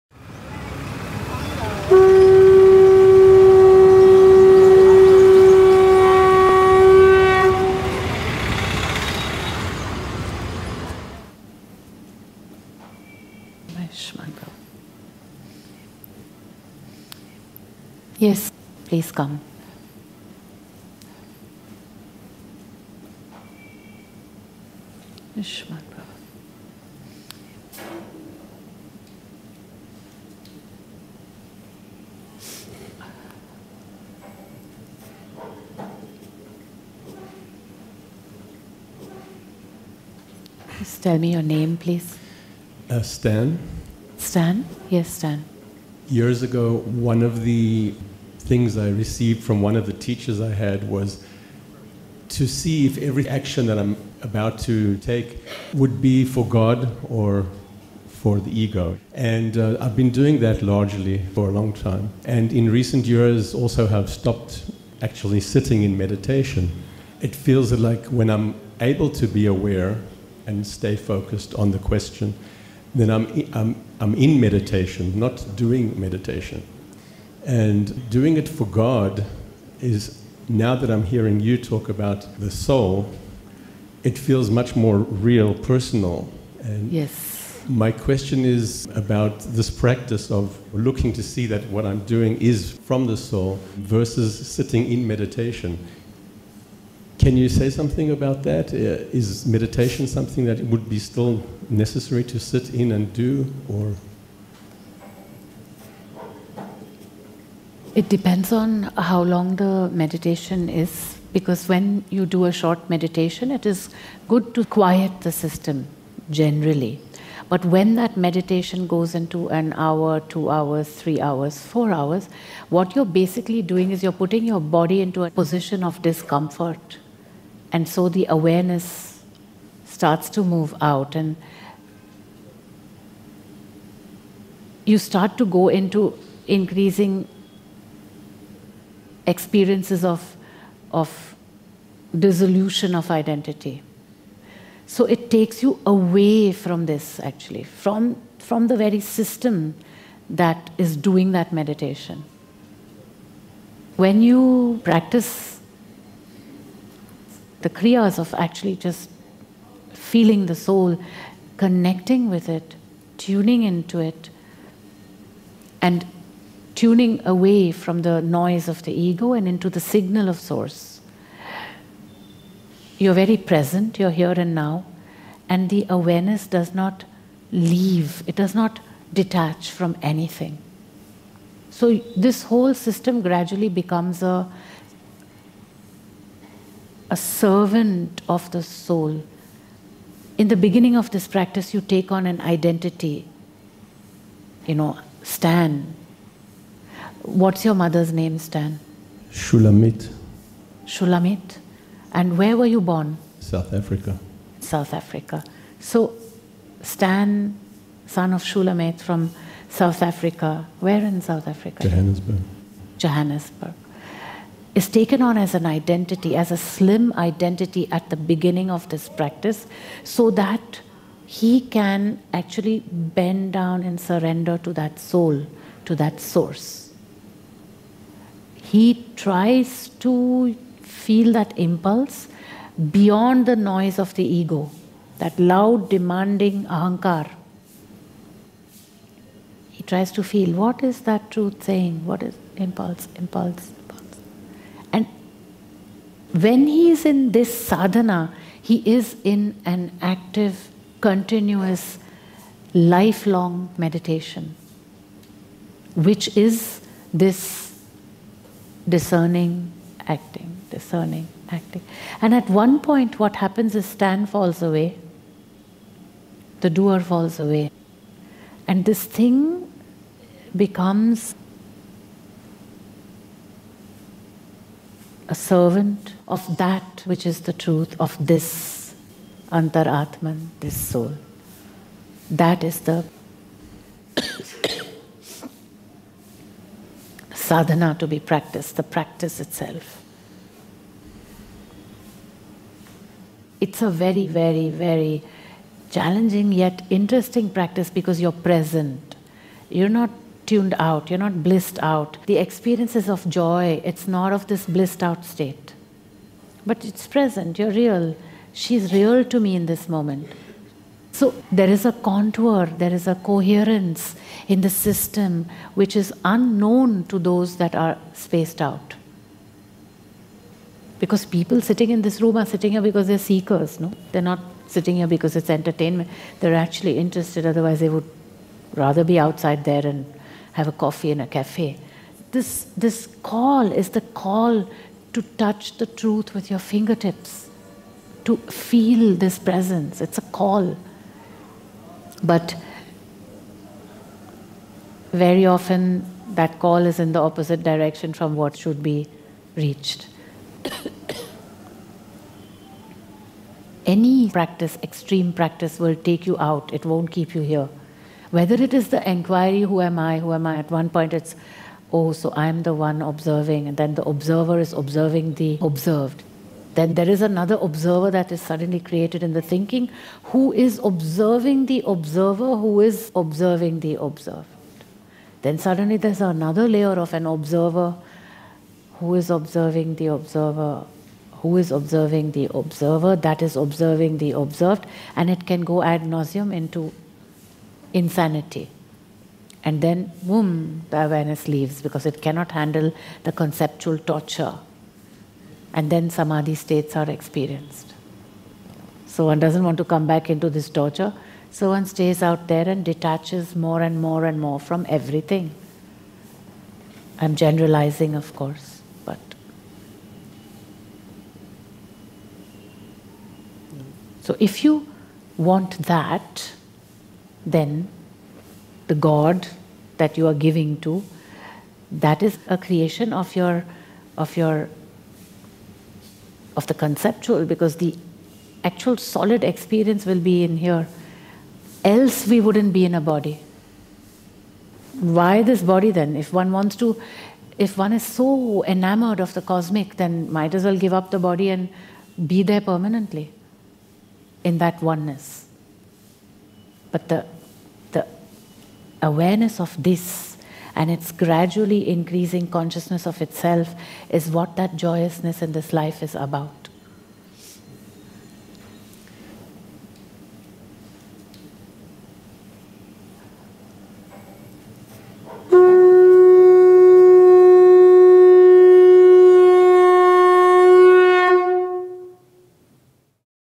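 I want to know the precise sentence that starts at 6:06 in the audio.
Then there is another observer that is suddenly created in the thinking who is observing the observer who is observing the observed.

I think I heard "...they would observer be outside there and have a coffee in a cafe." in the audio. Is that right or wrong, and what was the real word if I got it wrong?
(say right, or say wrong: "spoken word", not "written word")
wrong: "rather", not "observer".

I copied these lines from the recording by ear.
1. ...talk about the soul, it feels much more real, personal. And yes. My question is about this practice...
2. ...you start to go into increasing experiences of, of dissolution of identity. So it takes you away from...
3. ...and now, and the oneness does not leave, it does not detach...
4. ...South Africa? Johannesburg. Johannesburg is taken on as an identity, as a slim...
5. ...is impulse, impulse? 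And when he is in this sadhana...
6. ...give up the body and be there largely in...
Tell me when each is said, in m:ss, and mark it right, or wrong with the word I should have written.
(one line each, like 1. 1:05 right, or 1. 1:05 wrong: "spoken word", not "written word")
1. 1:21 right
2. 2:14 right
3. 2:54 wrong: "awareness", not "oneness"
4. 3:31 right
5. 4:02 right
6. 7:20 wrong: "permanently", not "largely".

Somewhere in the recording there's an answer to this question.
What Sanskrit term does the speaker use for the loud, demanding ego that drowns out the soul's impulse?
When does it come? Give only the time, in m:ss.
3:56.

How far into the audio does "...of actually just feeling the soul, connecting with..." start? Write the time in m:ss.
2:38.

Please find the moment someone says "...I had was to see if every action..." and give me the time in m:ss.
0:50.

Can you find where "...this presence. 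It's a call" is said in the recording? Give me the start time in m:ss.
5:39.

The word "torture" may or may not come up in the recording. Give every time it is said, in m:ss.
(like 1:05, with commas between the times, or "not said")
6:33, 6:40.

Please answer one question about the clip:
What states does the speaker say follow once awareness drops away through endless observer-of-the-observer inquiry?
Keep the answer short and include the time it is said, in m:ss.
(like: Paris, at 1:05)
samadhi states, at 6:36.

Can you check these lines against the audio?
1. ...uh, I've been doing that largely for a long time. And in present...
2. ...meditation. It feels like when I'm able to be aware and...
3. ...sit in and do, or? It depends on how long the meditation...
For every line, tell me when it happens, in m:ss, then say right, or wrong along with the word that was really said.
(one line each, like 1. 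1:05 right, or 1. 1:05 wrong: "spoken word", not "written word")
1. 0:59 wrong: "recent", not "present"
2. 1:05 right
3. 1:42 right.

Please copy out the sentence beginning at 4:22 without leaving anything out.
And at one point, what happens is Stan falls away, the doer falls away.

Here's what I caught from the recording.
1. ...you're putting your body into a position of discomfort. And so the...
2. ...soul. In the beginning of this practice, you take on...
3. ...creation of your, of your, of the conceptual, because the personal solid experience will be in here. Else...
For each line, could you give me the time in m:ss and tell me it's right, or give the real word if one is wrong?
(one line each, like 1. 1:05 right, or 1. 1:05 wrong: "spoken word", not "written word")
1. 2:04 right
2. 3:08 right
3. 7:02 wrong: "actual", not "personal".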